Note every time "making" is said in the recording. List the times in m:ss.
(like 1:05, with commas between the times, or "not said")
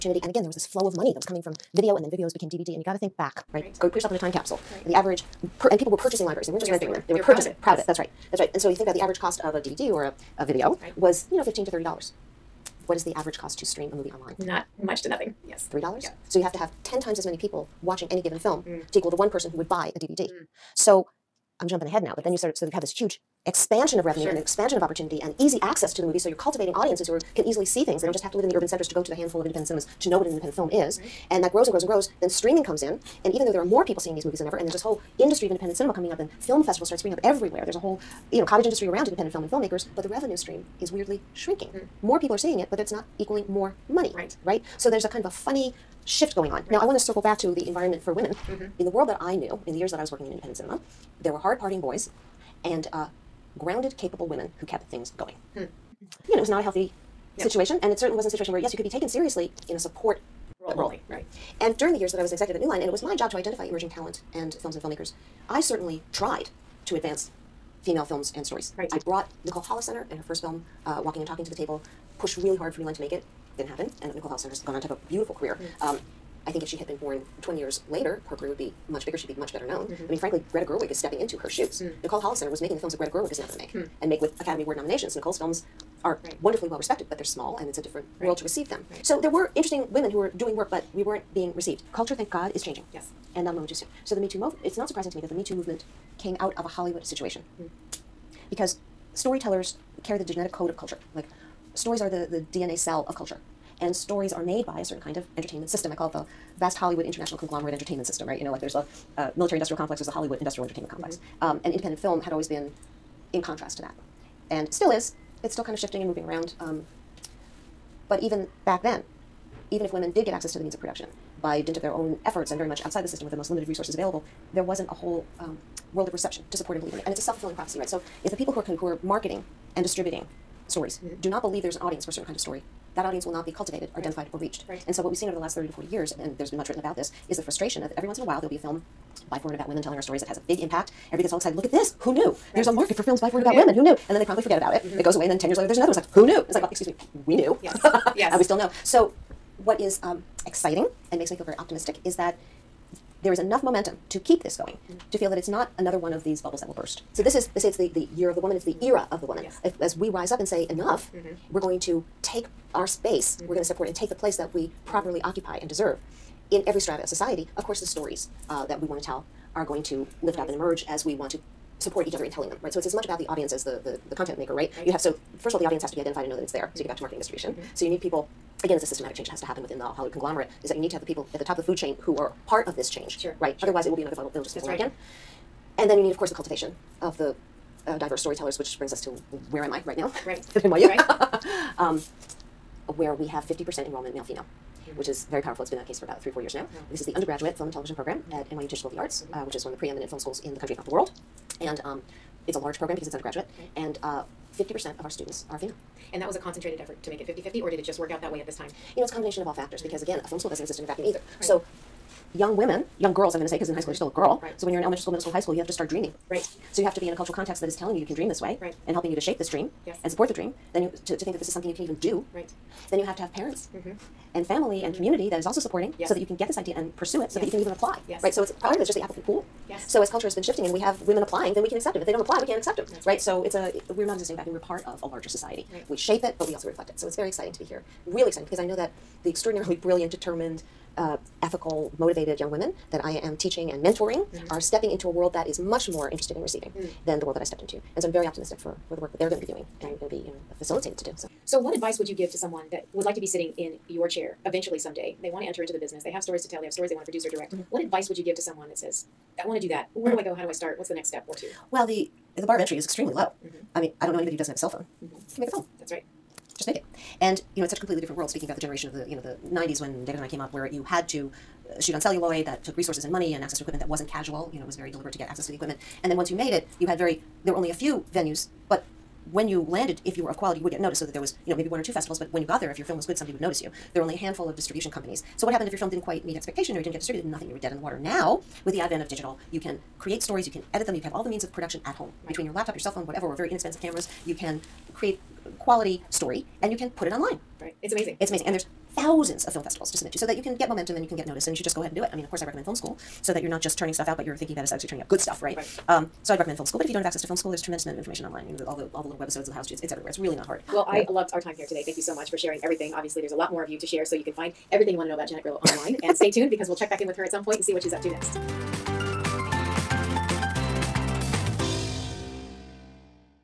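1:22.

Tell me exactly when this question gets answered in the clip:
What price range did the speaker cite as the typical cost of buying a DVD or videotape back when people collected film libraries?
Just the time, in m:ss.
0:11.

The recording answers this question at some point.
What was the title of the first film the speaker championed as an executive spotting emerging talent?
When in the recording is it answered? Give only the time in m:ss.
1:11.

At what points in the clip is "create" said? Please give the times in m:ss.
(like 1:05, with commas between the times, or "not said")
4:49, 4:54.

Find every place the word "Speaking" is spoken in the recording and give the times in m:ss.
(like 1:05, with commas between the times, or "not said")
4:28.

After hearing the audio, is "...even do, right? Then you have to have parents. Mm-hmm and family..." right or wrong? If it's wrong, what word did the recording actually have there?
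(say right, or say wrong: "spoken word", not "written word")
right.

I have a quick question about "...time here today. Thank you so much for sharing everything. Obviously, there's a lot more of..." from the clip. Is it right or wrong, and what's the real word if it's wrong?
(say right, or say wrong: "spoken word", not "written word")
right.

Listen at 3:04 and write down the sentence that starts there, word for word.
It'll just fizzle That's out right.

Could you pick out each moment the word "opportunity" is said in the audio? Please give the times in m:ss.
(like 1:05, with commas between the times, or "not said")
0:24.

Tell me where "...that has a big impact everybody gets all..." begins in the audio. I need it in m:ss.
2:20.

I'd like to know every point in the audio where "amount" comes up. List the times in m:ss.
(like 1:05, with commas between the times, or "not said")
5:07.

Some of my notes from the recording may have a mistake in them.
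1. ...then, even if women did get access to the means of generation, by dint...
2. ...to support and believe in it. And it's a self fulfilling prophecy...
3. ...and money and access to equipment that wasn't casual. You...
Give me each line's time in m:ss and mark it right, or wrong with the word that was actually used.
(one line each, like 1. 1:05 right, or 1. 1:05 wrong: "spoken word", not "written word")
1. 1:58 wrong: "production", not "generation"
2. 2:06 right
3. 4:33 right.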